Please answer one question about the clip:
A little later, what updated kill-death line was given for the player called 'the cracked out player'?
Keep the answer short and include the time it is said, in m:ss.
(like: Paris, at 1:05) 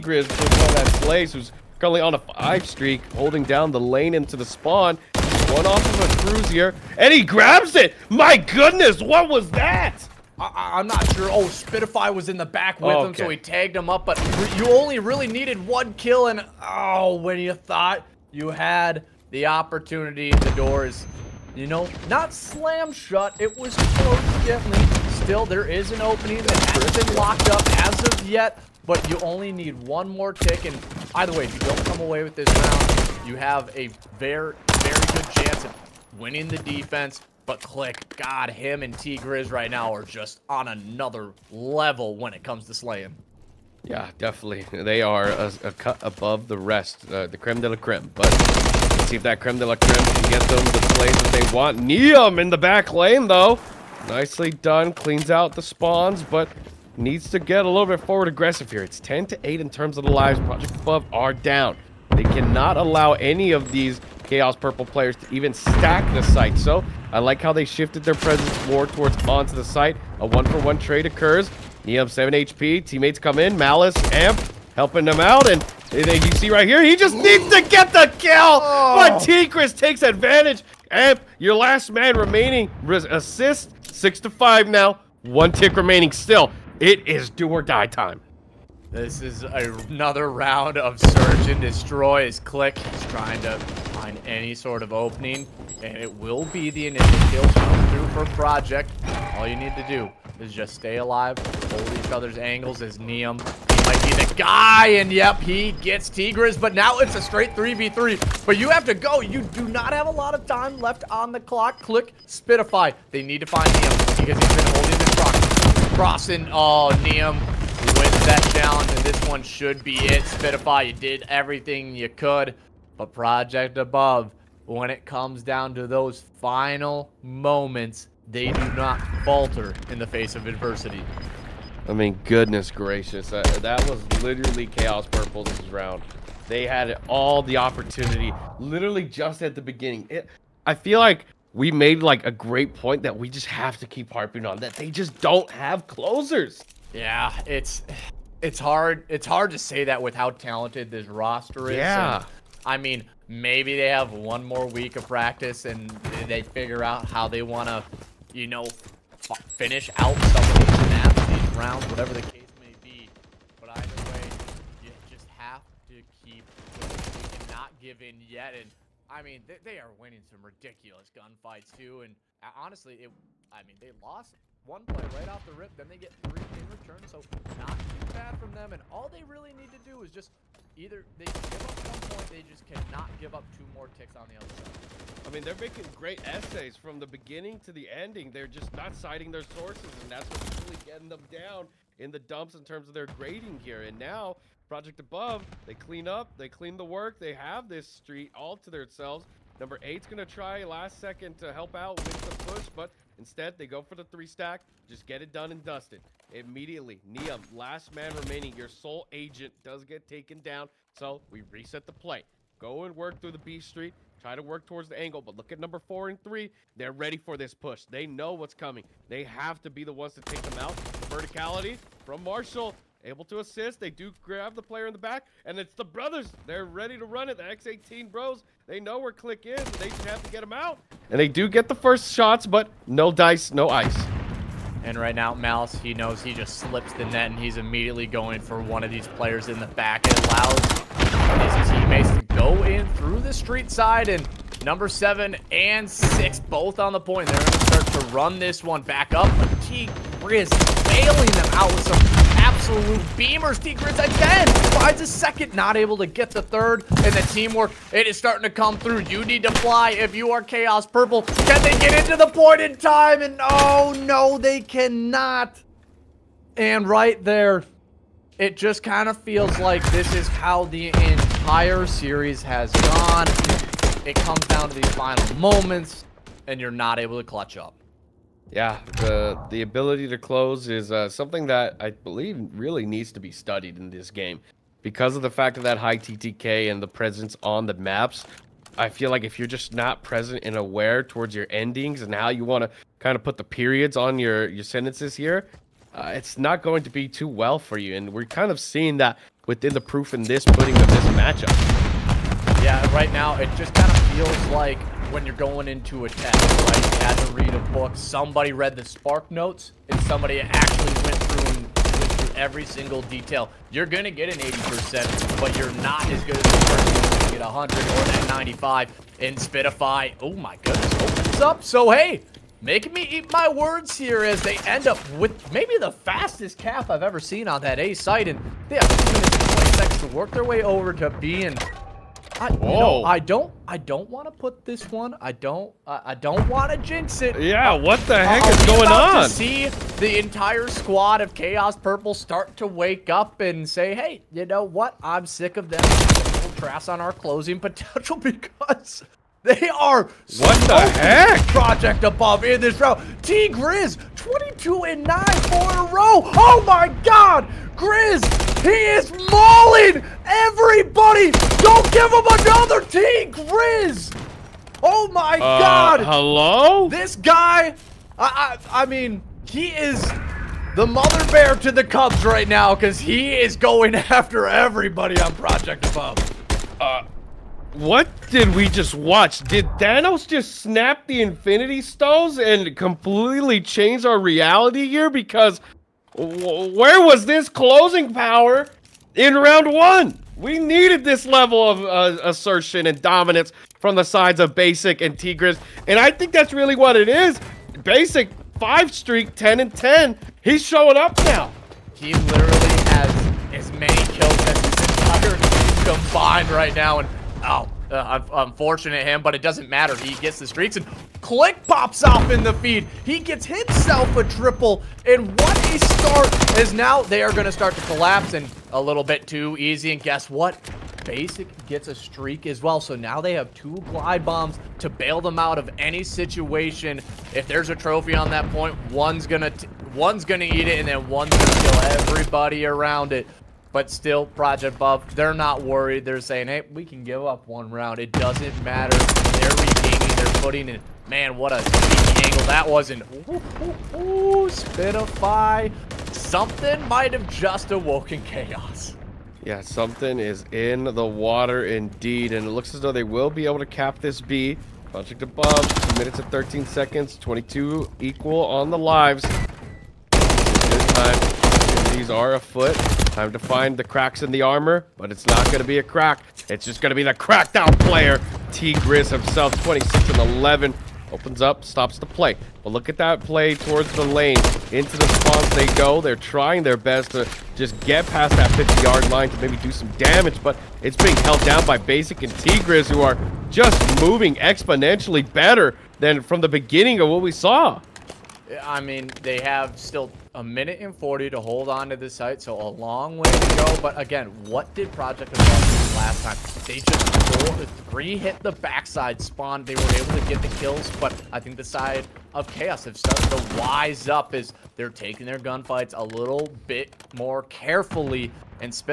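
26 and 11, at 7:49.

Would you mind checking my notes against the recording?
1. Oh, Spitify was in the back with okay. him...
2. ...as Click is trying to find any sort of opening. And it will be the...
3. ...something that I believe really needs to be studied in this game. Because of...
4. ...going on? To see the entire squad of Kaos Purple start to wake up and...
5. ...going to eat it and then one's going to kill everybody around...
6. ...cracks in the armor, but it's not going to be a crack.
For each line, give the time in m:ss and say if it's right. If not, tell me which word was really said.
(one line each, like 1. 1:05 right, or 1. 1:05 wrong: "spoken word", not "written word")
1. 0:11 right
2. 1:32 right
3. 4:41 right
4. 5:38 right
5. 7:10 right
6. 7:43 right.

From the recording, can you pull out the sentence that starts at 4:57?
And we're kind of seeing that within the proof in this pudding of this matchup.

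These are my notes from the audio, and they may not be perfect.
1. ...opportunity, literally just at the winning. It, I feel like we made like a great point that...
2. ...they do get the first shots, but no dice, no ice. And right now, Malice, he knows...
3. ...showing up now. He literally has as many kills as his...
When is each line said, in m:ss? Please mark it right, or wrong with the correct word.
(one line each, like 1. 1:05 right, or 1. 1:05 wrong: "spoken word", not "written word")
1. 2:17 wrong: "beginning", not "winning"
2. 3:51 right
3. 6:40 right.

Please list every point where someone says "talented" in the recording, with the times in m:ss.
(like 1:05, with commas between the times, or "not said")
2:30.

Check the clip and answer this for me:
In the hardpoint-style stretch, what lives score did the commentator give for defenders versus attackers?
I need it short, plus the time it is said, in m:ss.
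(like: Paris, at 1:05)
10 to 8, at 0:58.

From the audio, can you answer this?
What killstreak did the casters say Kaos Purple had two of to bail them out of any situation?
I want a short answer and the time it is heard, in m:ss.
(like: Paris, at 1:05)
Glide bombs, at 7:03.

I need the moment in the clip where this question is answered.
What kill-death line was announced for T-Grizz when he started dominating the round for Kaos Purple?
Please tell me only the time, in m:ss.
5:54.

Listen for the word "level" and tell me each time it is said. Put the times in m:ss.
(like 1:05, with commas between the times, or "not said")
0:41, 6:31.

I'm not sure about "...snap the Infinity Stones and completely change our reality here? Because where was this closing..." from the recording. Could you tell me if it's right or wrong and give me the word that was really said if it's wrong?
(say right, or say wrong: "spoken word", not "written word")
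right.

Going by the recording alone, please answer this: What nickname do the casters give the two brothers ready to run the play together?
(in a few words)
The X18 bros.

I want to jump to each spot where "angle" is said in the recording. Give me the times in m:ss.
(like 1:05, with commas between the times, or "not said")
1:42, 3:34, 7:22.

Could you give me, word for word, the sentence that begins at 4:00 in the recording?
It allows his teammates to go in through the street side and number seven and six both on the point.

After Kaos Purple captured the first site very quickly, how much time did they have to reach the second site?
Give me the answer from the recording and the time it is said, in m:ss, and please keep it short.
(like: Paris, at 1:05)
2 minutes and 20 seconds, at 5:28.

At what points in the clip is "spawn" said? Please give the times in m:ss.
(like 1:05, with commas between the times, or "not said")
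0:04, 0:55, 7:55, 8:19.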